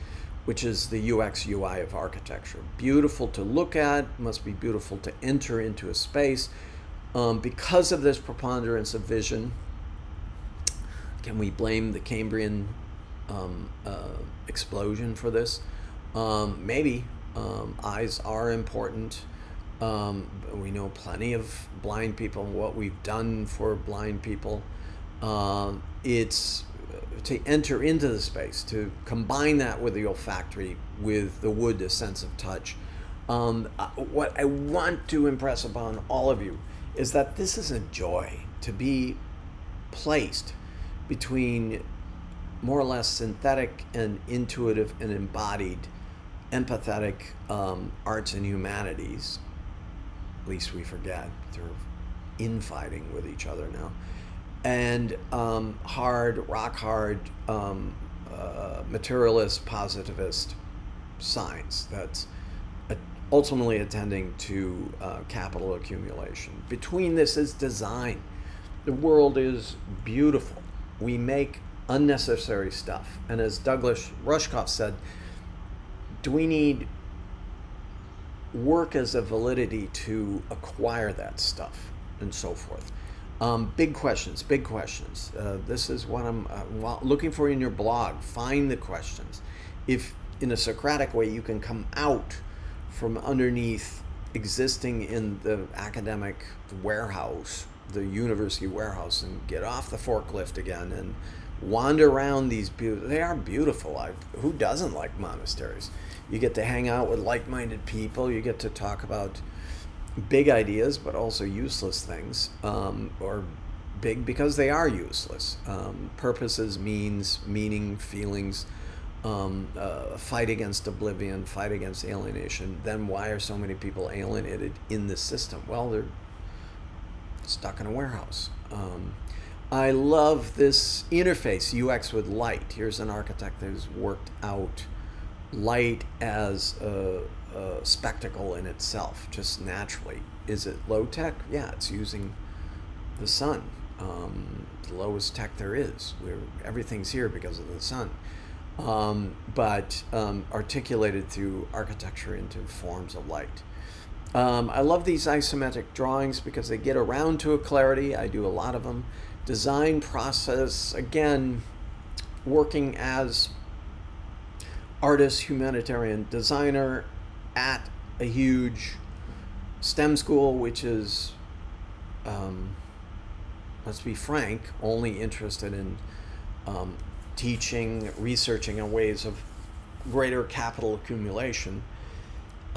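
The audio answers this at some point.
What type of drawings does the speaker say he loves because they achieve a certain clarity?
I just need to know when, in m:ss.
2:35.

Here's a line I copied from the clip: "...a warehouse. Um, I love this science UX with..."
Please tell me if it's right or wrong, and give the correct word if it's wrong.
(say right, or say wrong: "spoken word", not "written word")
wrong: "interface", not "science".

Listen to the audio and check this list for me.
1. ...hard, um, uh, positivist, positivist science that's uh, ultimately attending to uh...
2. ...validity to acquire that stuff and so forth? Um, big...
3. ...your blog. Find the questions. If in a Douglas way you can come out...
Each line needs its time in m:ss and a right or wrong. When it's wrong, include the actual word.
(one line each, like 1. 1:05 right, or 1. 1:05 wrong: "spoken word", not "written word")
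1. 0:56 wrong: "materialist", not "positivist"
2. 1:19 right
3. 1:27 wrong: "Socratic", not "Douglas".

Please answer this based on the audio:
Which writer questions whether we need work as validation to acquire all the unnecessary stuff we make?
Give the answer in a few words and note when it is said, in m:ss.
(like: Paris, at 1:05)
Douglas Rushkoff, at 1:13.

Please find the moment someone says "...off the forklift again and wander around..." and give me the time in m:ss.
1:39.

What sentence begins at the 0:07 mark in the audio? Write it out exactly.
Um, because of this preponderance of vision, can we blame the Cambrian um, uh, explosion for this?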